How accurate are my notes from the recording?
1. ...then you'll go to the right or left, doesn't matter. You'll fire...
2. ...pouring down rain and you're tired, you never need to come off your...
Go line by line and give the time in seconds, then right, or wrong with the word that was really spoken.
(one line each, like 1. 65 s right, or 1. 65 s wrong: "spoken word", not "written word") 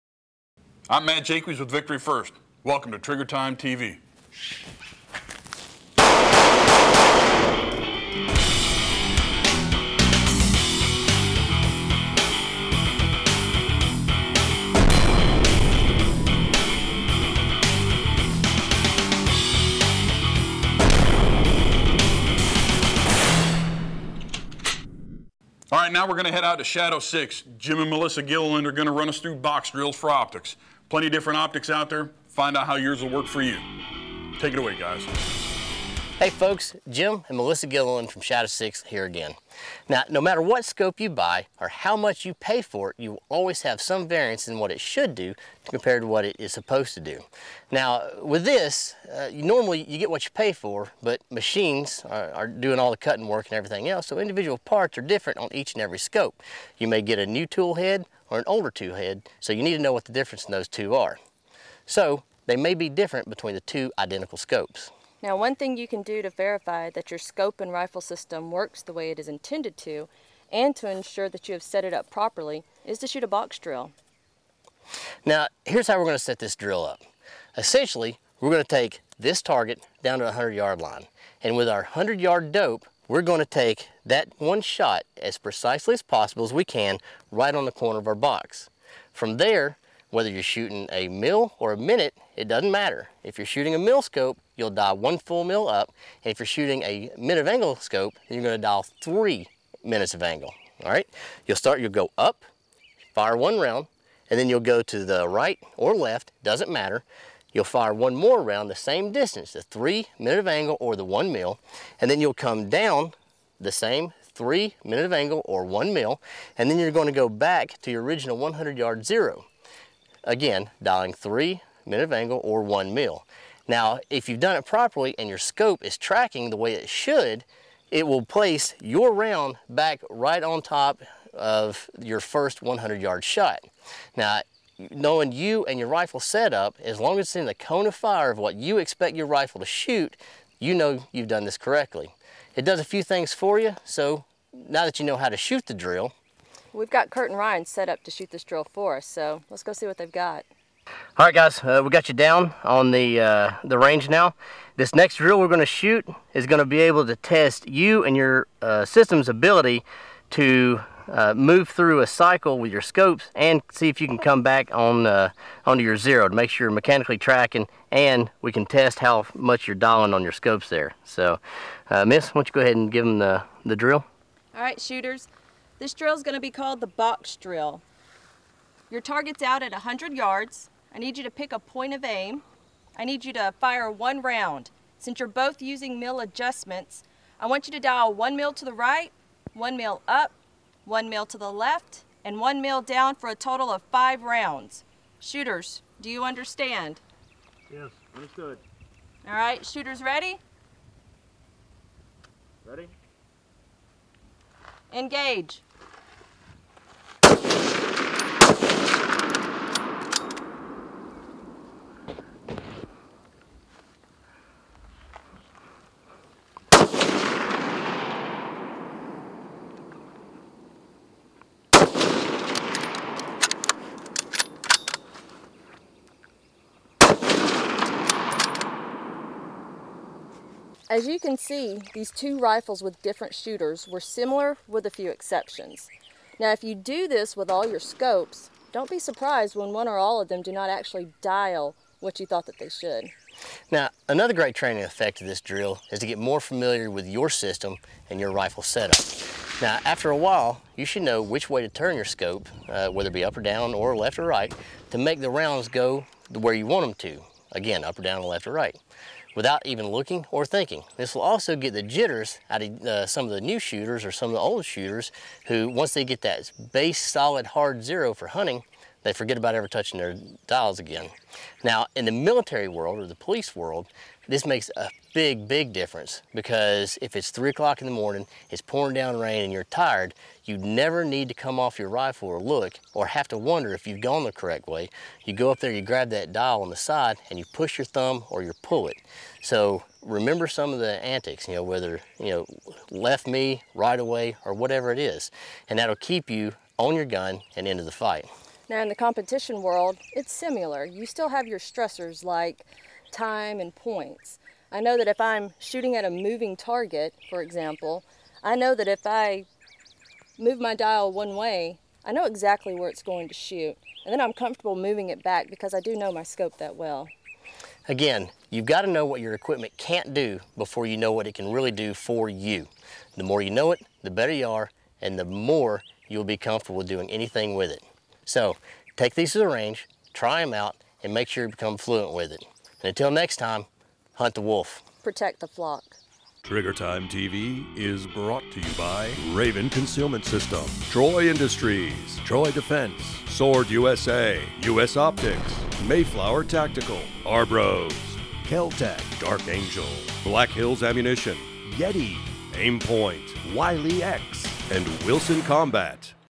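1. 104 s right
2. 278 s right.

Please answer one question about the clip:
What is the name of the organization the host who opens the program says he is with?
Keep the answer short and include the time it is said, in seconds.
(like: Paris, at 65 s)
Victory First, at 1 s.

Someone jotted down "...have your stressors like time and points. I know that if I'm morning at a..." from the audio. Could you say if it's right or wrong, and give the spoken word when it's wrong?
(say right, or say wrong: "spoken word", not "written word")
wrong: "shooting", not "morning".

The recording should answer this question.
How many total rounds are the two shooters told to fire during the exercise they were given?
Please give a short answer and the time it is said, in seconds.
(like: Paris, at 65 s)
5, at 193 s.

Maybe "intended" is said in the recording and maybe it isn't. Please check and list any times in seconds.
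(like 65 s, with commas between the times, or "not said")
69 s.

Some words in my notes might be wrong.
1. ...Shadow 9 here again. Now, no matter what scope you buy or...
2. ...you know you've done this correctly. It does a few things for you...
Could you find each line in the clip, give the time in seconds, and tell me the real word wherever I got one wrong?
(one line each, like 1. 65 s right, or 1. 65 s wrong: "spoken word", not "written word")
1. 38 s wrong: "6", not "9"
2. 140 s right.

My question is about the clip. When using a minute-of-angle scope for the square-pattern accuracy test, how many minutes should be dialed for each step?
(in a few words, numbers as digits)
3.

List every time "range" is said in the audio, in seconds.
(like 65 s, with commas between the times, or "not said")
153 s, 329 s.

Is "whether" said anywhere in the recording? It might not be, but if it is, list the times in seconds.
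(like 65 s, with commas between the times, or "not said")
90 s, 252 s, 291 s.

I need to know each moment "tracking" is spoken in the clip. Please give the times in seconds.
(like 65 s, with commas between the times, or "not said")
125 s, 167 s.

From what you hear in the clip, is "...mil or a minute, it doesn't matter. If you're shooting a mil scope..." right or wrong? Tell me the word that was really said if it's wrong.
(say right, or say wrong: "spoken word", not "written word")
right.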